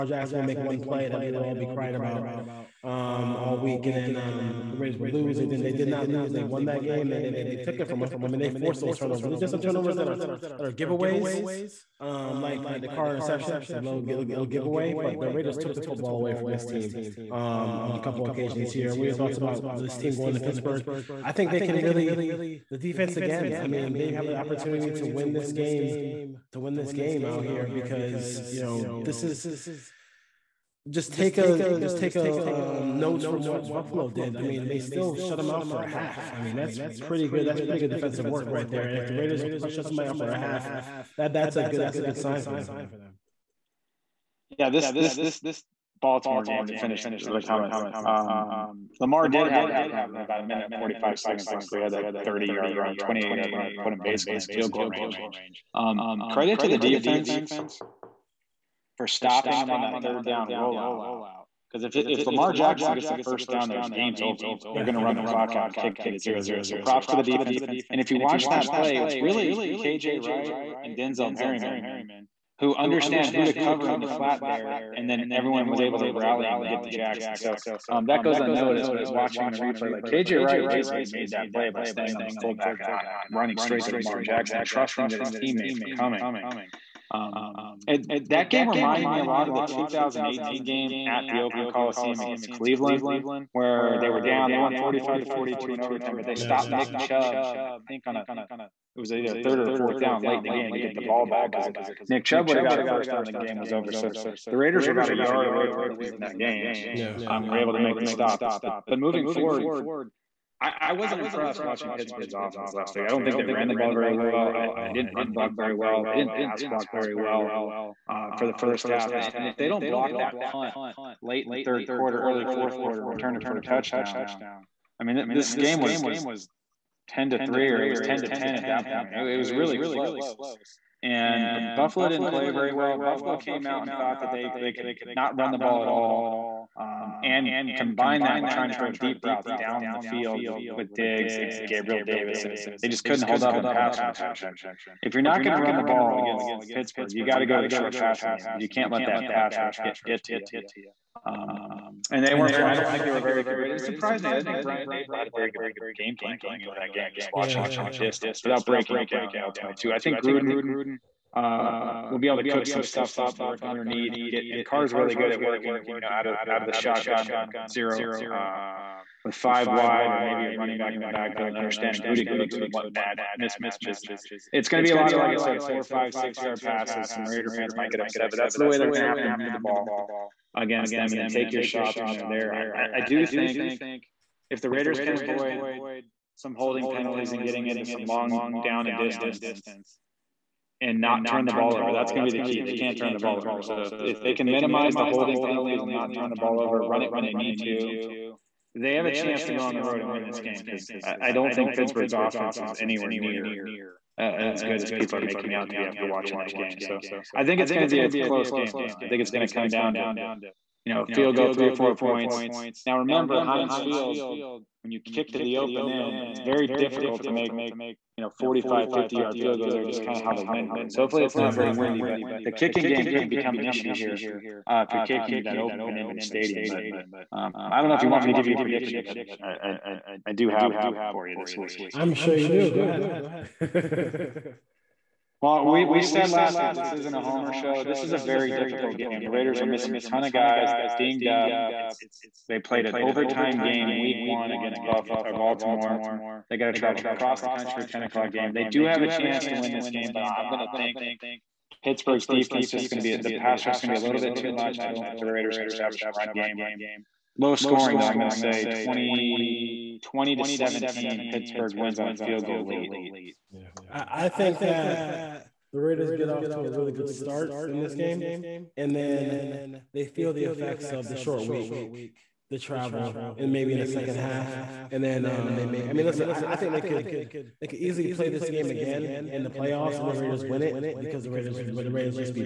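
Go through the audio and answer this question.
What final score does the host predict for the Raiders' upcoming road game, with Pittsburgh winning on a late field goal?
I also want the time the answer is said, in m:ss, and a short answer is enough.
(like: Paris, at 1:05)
20 to 17, at 4:20.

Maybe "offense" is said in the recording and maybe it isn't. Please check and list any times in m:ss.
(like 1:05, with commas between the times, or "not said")
1:52, 3:22.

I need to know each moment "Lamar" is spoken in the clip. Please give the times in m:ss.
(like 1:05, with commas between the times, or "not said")
0:48, 1:02, 1:23.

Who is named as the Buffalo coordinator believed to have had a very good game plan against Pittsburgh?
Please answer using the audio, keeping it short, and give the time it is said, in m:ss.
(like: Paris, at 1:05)
Brian Daboll, at 2:34.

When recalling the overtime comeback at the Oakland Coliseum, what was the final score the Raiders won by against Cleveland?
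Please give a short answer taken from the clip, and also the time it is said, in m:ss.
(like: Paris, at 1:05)
45 to 42, at 1:34.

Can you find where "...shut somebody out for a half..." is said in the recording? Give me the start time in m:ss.
0:39.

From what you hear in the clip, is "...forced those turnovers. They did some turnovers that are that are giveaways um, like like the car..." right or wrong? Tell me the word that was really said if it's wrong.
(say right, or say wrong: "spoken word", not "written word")
right.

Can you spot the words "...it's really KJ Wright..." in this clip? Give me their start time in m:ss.
1:08.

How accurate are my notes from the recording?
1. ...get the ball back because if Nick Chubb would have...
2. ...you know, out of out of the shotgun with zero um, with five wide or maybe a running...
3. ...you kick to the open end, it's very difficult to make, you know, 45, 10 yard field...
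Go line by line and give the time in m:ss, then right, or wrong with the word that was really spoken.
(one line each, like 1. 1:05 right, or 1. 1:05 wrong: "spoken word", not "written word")
1. 1:40 right
2. 2:45 right
3. 3:34 wrong: "50", not "10".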